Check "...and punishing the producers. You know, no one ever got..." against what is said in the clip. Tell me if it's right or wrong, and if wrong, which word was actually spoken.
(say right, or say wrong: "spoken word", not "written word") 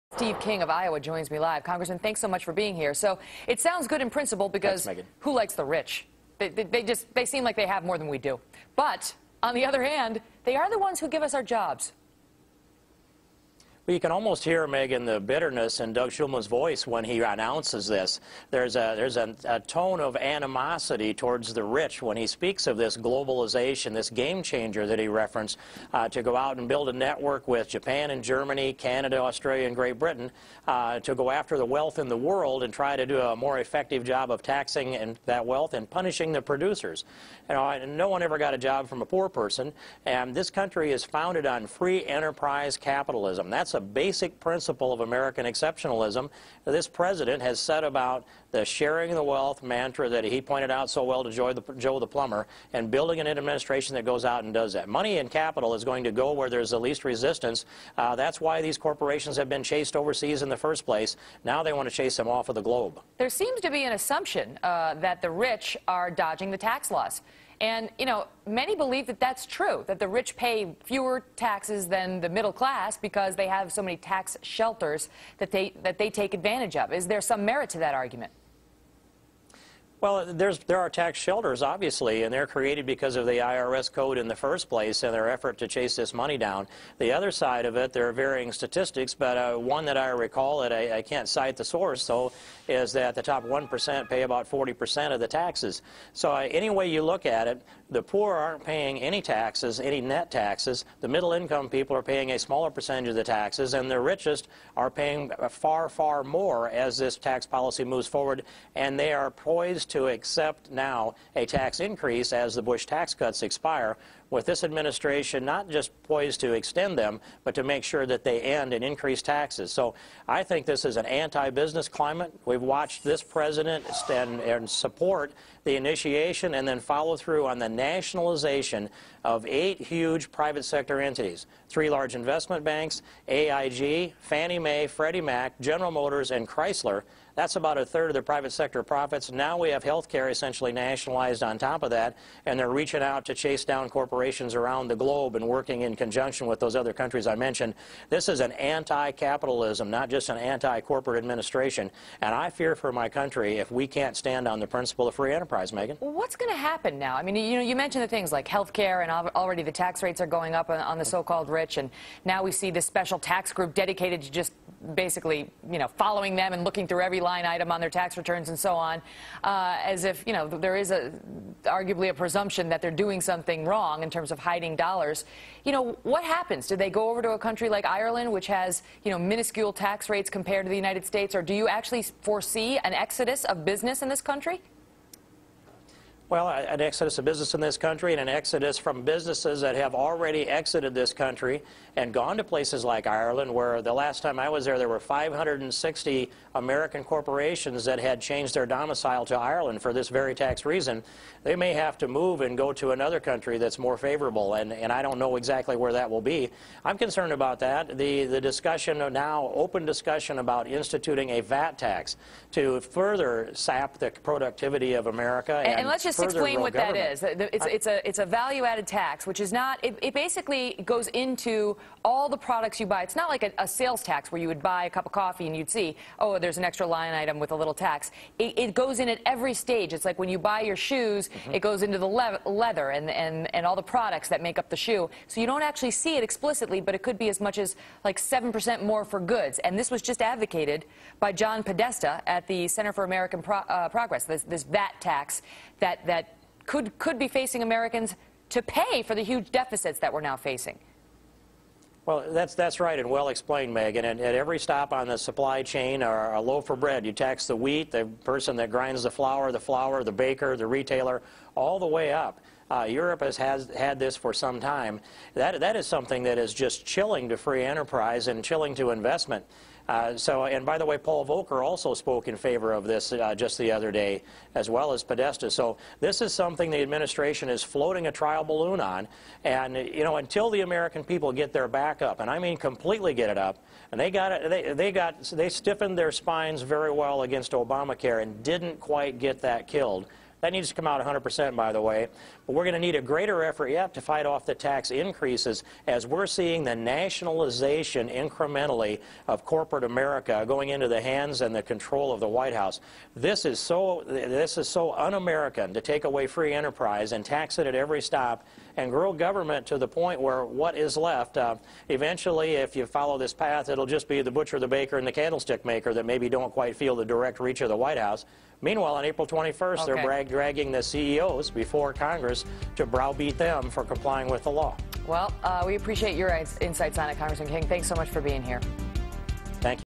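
right.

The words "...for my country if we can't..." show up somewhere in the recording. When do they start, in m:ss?
2:32.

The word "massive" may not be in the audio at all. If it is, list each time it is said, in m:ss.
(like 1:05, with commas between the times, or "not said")
not said.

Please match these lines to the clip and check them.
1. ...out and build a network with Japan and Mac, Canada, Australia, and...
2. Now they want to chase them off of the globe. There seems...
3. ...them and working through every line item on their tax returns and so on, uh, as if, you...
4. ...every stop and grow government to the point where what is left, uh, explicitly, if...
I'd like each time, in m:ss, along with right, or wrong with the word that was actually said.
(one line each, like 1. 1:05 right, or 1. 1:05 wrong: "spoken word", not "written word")
1. 0:26 wrong: "Germany", not "Mac"
2. 1:01 right
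3. 2:46 wrong: "looking", not "working"
4. 5:07 wrong: "eventually", not "explicitly".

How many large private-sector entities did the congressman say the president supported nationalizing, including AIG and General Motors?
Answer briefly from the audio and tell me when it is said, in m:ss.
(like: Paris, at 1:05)
8, at 2:09.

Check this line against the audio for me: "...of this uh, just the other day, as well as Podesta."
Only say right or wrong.
right.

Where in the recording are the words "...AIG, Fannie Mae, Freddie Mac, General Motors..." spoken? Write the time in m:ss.
2:13.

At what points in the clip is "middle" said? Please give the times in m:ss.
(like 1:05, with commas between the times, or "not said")
1:12, 1:41.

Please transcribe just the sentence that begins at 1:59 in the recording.
So I think this is an anti-business climate.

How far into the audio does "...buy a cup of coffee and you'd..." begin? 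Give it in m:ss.
3:44.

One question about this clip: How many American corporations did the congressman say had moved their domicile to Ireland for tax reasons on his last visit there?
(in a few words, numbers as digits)
560.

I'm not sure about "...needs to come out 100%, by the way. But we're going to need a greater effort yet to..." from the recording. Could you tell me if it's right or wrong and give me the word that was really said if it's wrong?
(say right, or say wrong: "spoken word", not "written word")
right.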